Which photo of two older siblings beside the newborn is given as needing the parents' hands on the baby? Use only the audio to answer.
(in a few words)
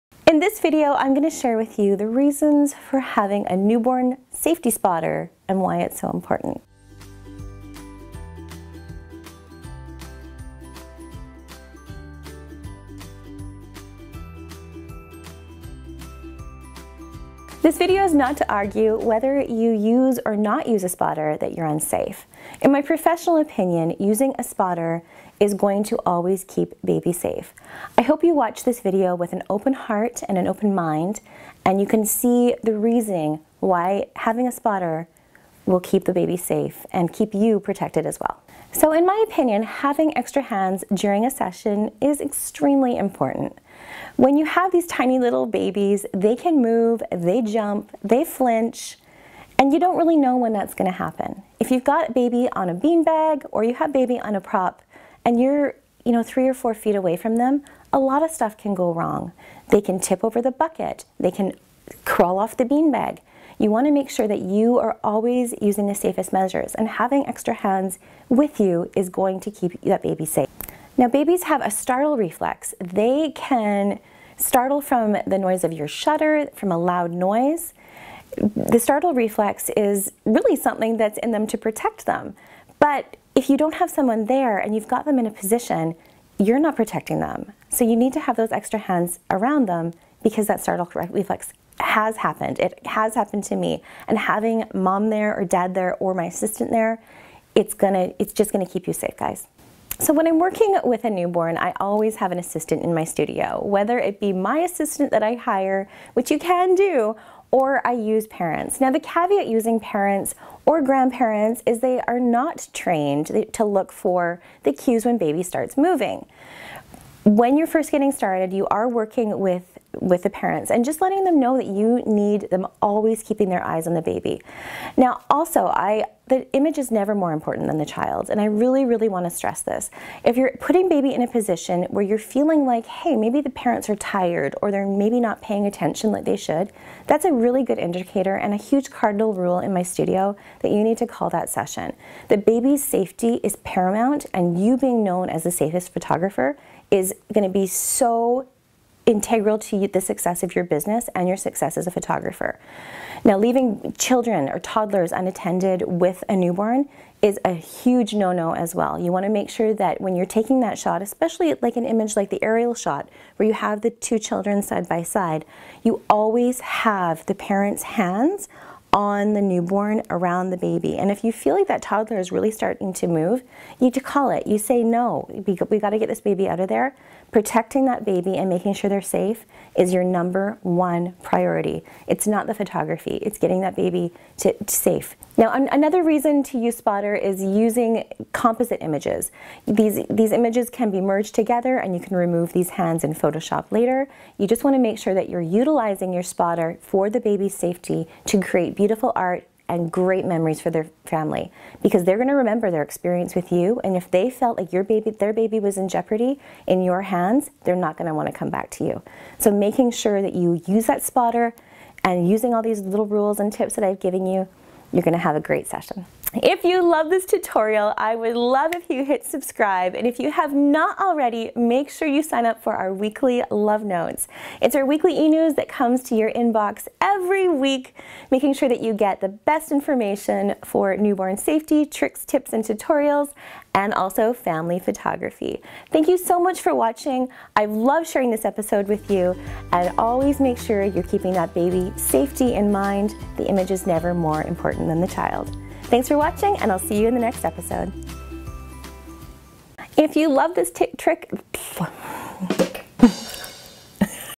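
The aerial shot.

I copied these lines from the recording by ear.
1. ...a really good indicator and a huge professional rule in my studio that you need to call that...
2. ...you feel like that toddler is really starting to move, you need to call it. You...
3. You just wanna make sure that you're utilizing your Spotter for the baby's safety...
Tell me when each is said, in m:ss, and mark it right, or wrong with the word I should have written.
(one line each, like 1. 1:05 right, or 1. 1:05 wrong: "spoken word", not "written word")
1. 2:17 wrong: "cardinal", not "professional"
2. 2:51 right
3. 3:14 right.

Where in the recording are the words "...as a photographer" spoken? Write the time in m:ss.
2:31.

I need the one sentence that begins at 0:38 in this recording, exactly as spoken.
So in my opinion, having extra hands during a session is extremely important.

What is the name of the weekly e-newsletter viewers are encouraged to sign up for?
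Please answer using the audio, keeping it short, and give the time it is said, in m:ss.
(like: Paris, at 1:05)
Love Notes, at 3:43.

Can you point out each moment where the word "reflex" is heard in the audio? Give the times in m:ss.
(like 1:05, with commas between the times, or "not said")
1:12, 1:19, 1:30.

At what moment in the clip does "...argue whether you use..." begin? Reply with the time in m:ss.
0:18.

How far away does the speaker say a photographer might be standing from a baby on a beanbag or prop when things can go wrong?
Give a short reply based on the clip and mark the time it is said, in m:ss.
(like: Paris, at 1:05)
3 or 4 feet, at 0:56.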